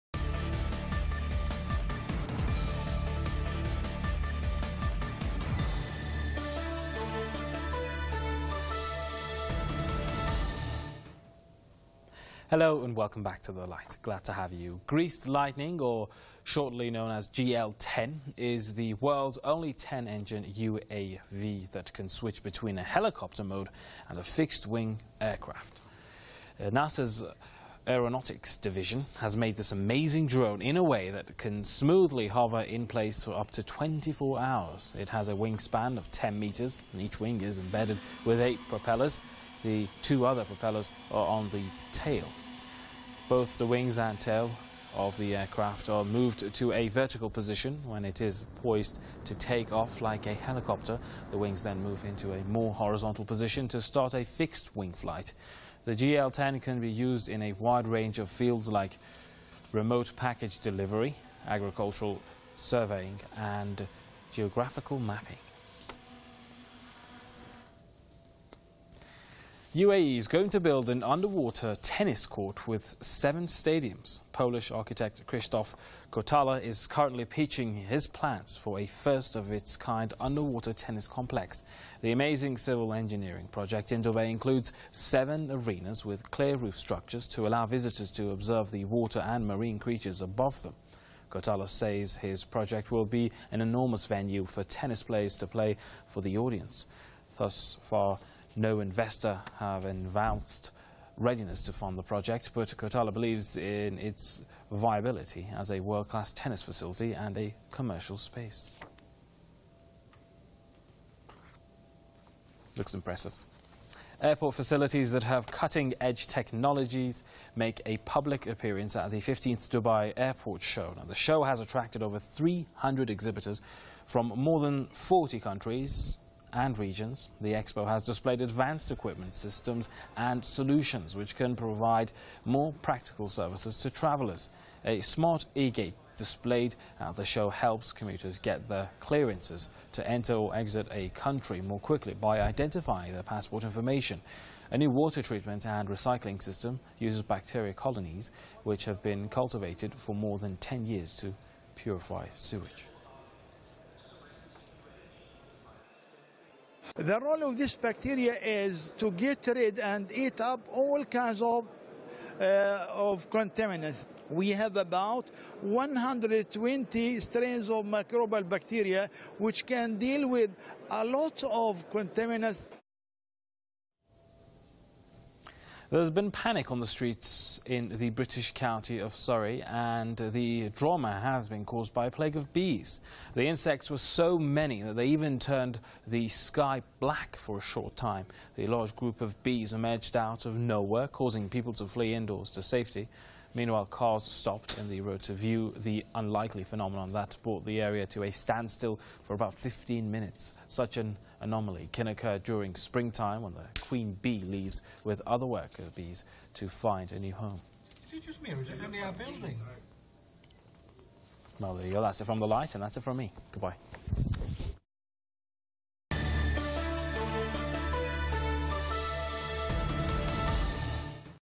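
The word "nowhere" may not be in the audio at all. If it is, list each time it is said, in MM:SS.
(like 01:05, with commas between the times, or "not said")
03:10.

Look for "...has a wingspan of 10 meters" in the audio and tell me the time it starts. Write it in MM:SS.
00:35.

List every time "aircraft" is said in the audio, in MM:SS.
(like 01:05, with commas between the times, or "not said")
00:25, 00:45.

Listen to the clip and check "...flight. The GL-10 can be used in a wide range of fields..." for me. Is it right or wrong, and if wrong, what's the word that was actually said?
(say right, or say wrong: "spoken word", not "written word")
right.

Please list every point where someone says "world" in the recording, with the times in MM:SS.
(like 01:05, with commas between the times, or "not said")
00:18, 01:45.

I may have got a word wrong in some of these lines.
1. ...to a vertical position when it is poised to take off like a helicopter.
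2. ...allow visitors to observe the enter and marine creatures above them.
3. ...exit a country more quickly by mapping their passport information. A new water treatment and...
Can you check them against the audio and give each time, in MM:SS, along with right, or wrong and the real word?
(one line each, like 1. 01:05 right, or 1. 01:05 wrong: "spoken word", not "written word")
1. 00:46 right
2. 01:27 wrong: "water", not "enter"
3. 02:20 wrong: "identifying", not "mapping".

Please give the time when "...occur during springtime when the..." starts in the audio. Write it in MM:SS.
03:22.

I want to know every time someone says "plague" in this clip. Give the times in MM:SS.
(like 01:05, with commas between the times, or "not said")
03:02.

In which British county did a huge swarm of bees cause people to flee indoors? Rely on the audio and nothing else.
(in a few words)
Surrey.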